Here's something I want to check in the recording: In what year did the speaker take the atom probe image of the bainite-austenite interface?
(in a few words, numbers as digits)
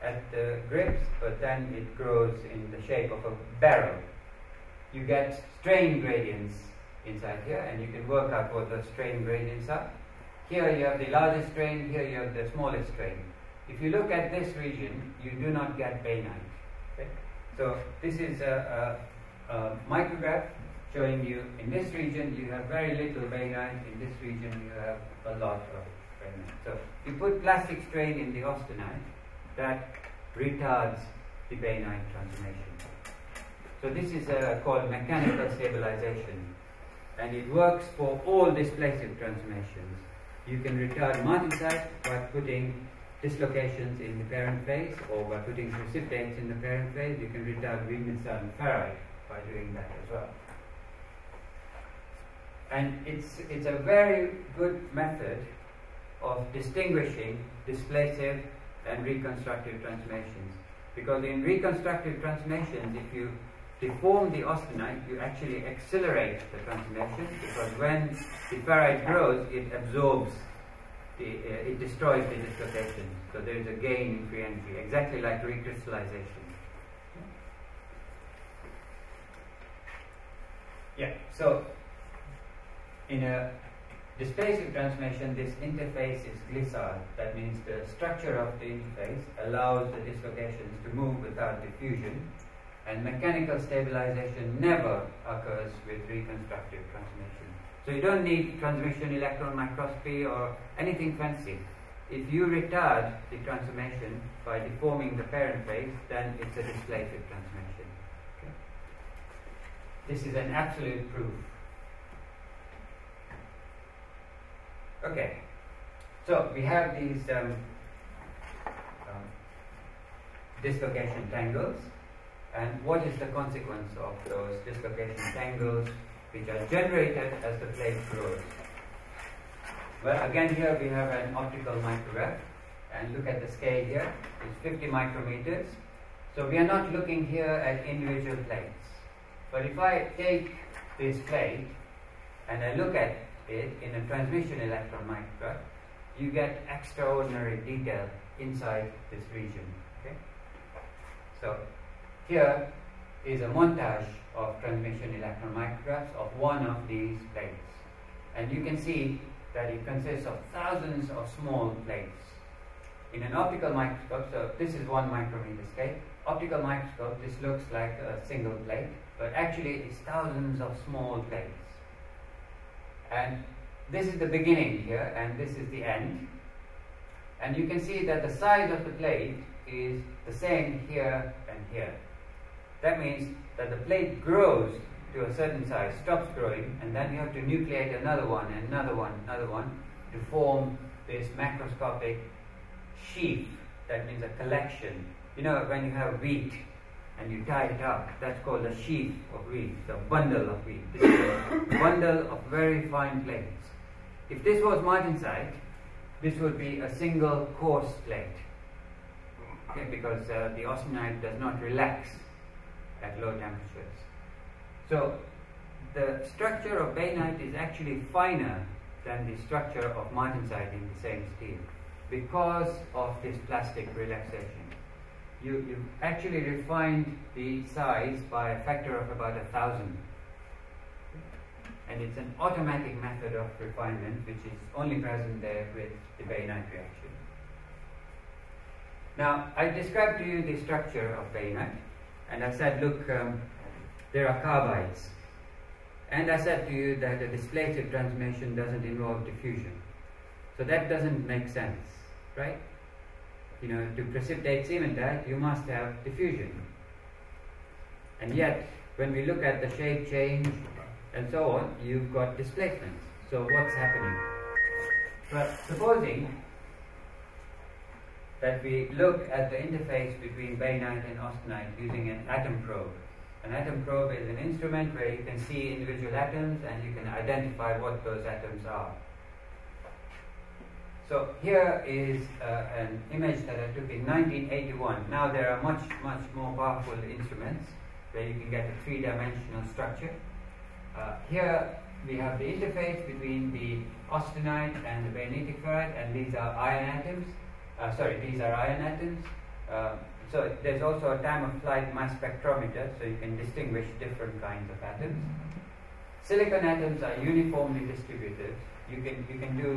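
1981.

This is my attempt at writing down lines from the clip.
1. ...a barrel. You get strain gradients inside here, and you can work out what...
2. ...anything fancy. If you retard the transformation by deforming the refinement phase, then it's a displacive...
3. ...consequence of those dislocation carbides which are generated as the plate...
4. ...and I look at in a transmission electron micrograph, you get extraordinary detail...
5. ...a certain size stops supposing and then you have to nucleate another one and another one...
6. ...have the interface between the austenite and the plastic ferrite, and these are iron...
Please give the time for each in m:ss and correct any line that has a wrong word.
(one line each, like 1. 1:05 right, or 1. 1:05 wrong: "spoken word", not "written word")
1. 0:03 right
2. 1:40 wrong: "parent", not "refinement"
3. 2:03 wrong: "tangles", not "carbides"
4. 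2:22 right
5. 3:05 wrong: "growing", not "supposing"
6. 4:52 wrong: "bainitic", not "plastic".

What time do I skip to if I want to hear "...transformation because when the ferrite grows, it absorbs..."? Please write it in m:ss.
1:06.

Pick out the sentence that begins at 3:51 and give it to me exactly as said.
And it's an automatic method of refinement which is only present there with the Bainite reaction.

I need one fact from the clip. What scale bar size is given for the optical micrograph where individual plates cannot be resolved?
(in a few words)
50 micrometers.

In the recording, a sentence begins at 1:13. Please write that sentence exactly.
So there is a gain in free energy, exactly like recrystallization.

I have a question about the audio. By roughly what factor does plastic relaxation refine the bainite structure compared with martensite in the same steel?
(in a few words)
about a thousand.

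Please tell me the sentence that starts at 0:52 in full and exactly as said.
And it's, it's a very good method of distinguishing displacive and reconstructive transformations.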